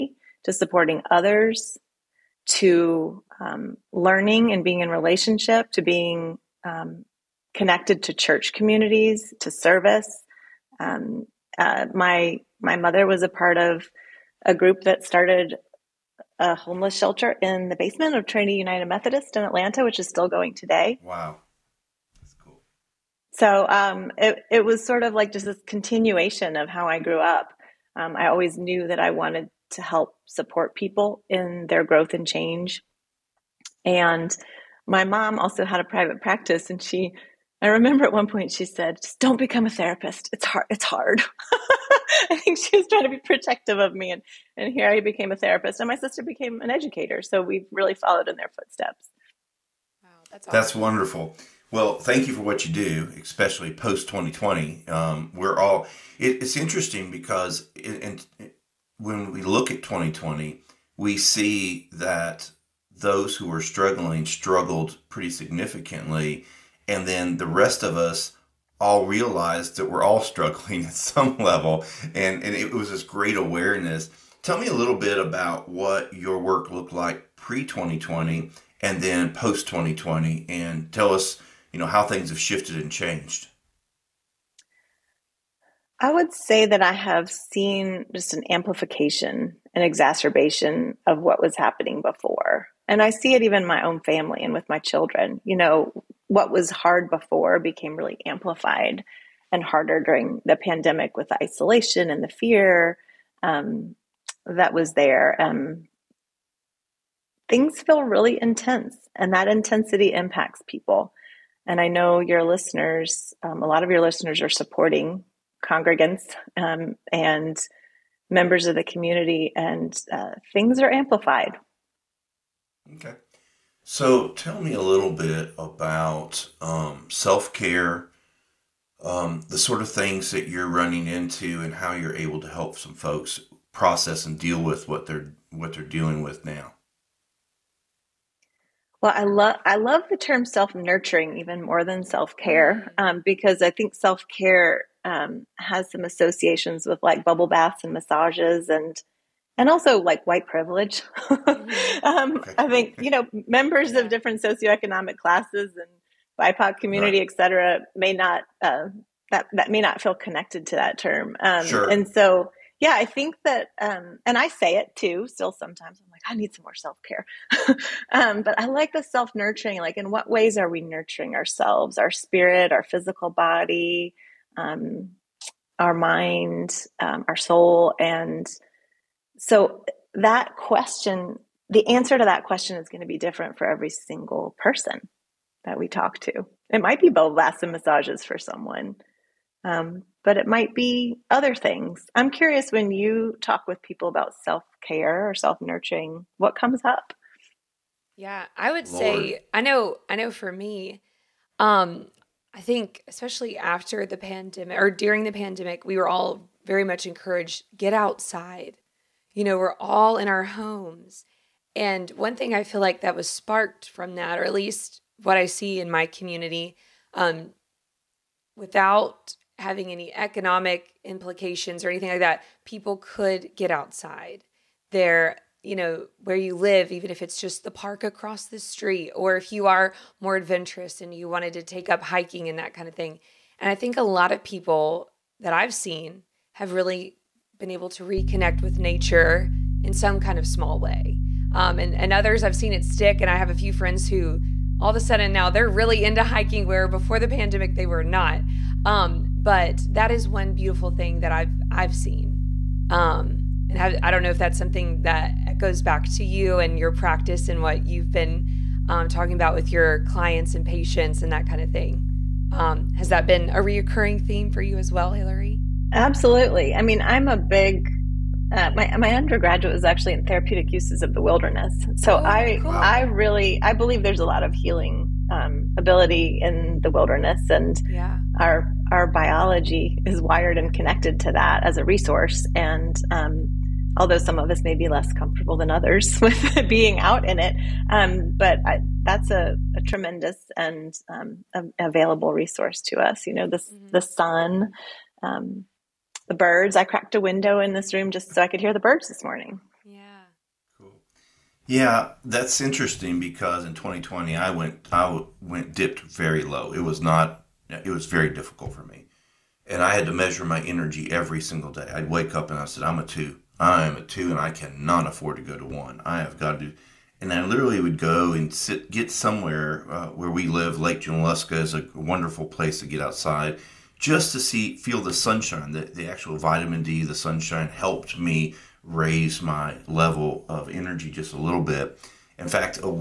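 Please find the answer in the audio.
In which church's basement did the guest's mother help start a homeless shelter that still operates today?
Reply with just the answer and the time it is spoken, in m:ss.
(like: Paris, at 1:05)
Trinity United Methodist, at 0:18.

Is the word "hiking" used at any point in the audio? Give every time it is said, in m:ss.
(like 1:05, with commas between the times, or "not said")
3:52, 4:06.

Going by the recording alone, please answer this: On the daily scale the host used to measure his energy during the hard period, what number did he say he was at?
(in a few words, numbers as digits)
2.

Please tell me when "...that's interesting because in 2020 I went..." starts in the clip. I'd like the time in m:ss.
5:02.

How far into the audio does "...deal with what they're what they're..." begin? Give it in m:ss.
2:14.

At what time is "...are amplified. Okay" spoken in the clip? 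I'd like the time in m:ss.
2:00.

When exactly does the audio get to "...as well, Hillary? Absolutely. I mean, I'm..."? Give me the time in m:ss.
4:24.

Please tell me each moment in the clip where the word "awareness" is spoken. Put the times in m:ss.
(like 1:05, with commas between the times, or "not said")
1:13.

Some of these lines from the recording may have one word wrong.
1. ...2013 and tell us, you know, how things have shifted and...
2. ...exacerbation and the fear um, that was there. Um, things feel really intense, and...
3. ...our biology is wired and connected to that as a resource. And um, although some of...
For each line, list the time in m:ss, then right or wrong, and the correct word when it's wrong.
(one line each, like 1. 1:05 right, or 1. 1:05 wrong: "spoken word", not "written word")
1. 1:19 wrong: "2020", not "2013"
2. 1:41 wrong: "isolation", not "exacerbation"
3. 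4:38 right.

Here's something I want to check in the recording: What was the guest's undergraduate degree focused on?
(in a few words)
therapeutic uses of the wilderness.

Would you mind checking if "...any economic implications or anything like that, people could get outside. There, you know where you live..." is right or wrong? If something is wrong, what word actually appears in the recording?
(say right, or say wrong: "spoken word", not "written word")
right.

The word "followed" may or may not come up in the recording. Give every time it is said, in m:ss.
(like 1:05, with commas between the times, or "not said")
0:47.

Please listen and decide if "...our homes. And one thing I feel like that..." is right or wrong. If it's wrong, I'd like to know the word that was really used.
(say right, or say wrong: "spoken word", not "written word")
right.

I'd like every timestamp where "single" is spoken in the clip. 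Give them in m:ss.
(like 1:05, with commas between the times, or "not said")
3:03, 5:11.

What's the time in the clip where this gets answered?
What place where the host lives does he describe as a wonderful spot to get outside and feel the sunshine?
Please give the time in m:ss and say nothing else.
5:20.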